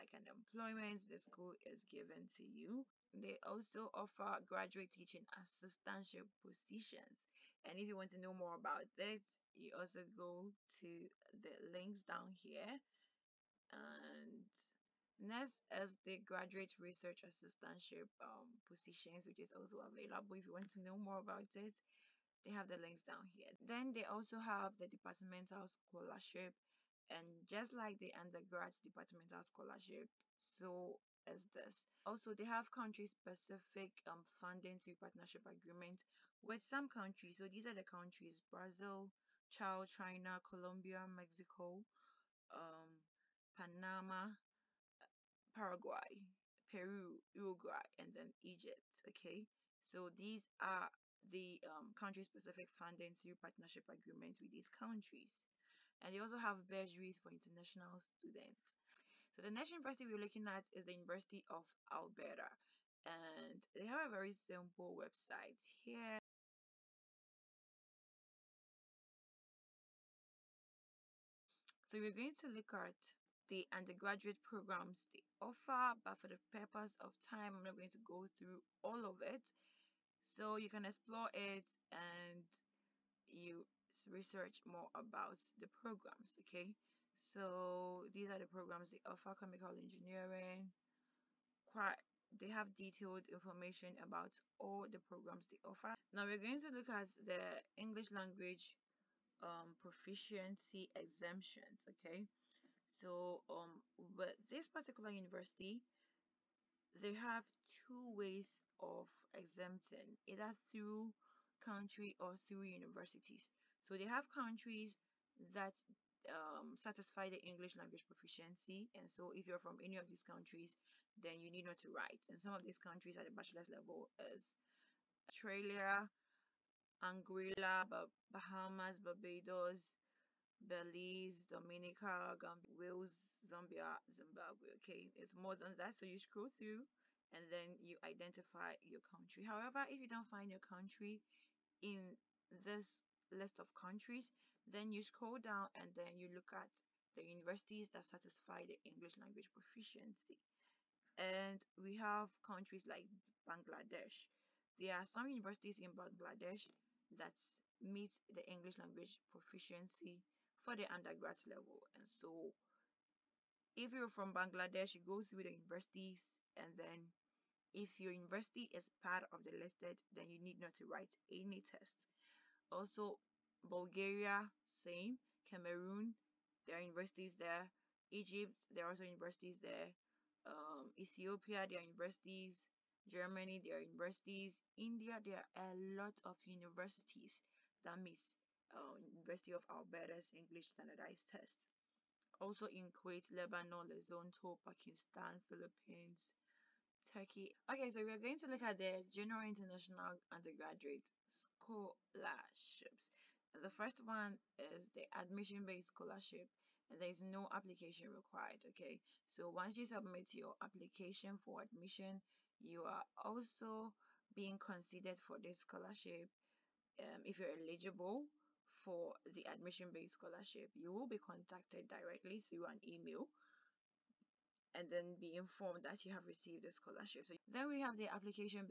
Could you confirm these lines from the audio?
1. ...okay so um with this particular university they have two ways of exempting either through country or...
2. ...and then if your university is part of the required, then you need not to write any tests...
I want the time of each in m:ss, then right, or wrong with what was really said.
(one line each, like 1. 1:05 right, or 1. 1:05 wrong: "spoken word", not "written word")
1. 1:41 right
2. 2:46 wrong: "listed", not "required".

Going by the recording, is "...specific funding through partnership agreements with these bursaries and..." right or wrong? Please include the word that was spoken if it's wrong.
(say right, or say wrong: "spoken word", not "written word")
wrong: "countries", not "bursaries".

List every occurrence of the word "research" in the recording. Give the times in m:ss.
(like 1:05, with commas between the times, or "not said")
0:16, 1:24.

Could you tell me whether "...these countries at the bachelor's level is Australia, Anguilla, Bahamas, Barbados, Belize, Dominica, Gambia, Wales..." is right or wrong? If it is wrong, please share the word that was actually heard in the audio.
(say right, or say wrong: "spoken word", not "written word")
right.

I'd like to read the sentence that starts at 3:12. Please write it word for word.
Also in Kuwait, Lebanon, Lesotho, Pakistan, Philippines, Turkey.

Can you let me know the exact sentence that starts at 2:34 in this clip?
There are some universities in Bangladesh that meet the English language proficiency for the undergrad level.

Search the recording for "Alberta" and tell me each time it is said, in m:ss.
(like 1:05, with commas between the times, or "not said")
1:01, 3:09.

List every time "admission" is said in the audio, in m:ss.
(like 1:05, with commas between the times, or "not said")
3:25, 3:31, 3:39.